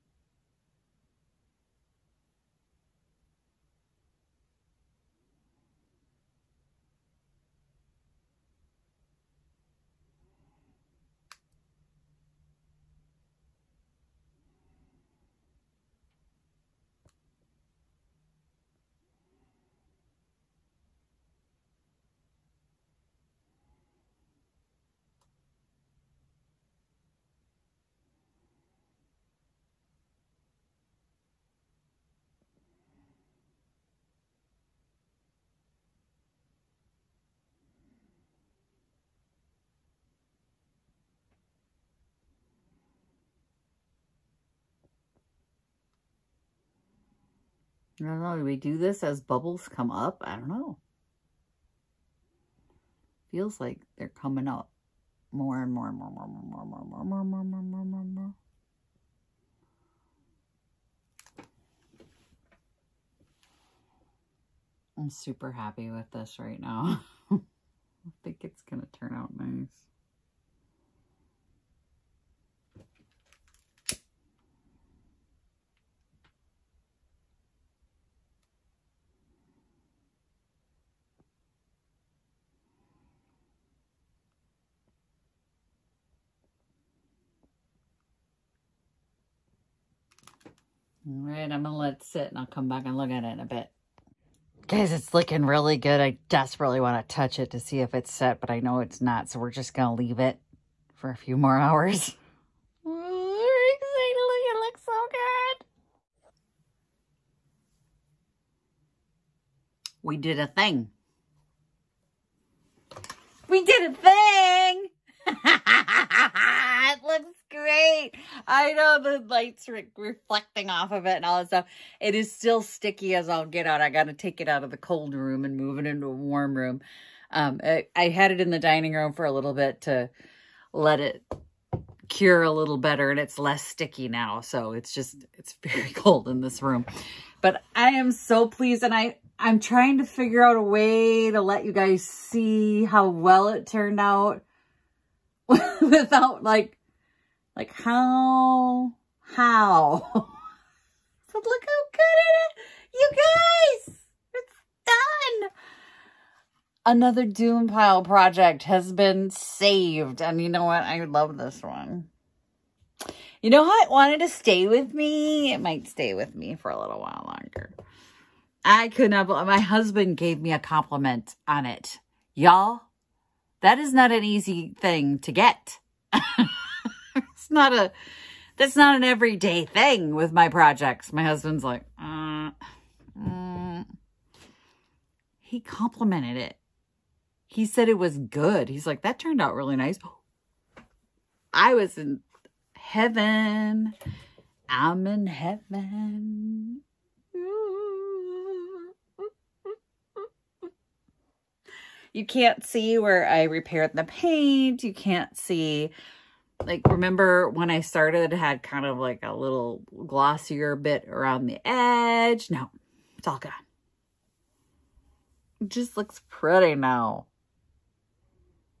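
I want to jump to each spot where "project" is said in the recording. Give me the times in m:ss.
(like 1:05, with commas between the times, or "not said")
2:38, 3:00.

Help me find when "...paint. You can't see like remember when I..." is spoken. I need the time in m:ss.
3:24.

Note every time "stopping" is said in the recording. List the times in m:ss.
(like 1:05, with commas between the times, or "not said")
not said.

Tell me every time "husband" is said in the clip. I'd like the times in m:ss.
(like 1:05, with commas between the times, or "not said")
2:49, 3:01.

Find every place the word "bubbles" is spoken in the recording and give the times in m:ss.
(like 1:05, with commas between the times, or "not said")
0:49.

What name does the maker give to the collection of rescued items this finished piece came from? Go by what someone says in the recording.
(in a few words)
Doom Pile.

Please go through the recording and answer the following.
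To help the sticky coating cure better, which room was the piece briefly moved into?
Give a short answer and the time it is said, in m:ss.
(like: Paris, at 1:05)
dining room, at 2:08.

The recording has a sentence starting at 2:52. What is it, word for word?
Y'all, that is not an easy thing to get.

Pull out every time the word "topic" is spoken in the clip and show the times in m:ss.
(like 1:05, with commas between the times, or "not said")
not said.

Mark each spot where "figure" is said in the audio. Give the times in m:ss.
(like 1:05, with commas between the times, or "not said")
2:20.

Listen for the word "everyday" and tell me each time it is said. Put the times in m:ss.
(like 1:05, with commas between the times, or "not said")
2:59.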